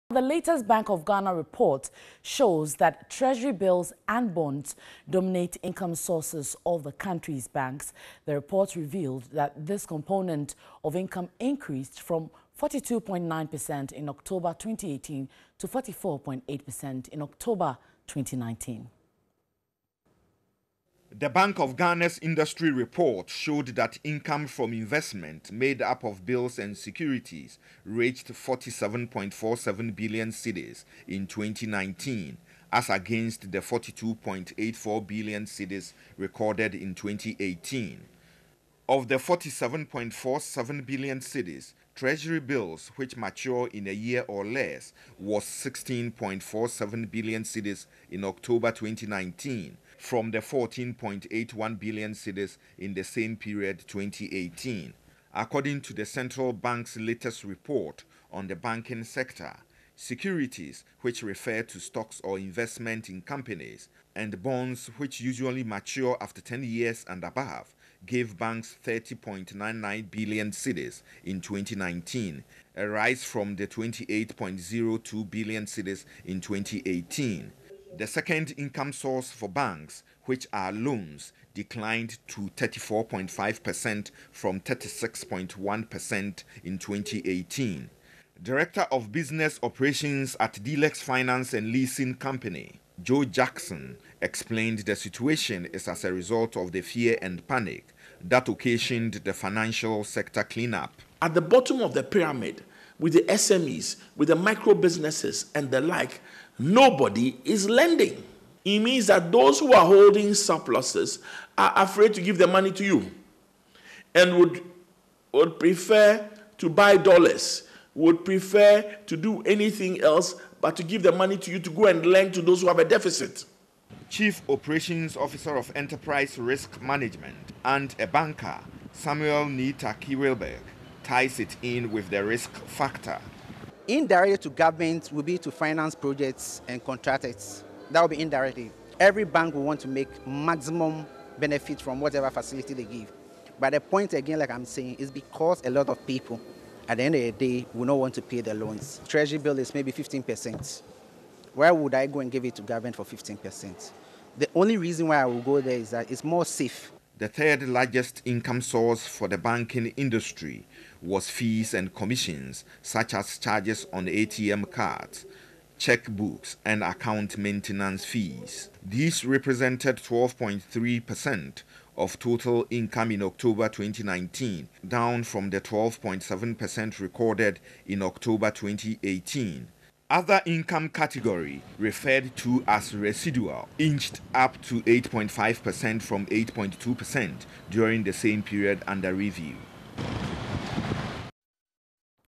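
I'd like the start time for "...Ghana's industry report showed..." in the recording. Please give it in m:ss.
0:21.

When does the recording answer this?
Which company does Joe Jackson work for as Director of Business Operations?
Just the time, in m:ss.
1:30.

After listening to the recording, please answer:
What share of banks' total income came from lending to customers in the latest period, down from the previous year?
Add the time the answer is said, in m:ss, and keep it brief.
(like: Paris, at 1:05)
34.5%, at 1:22.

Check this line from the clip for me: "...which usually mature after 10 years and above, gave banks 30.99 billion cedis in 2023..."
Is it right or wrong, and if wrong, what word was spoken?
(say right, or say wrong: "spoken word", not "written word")
wrong: "2019", not "2023".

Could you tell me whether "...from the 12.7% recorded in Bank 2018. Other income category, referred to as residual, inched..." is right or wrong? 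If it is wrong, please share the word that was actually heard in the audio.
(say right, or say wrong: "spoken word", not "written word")
wrong: "October", not "Bank".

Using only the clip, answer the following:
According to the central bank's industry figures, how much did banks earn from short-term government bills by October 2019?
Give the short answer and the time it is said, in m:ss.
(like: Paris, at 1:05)
16.47 billion cedis, at 0:45.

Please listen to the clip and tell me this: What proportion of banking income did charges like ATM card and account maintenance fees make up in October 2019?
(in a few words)
12.3%.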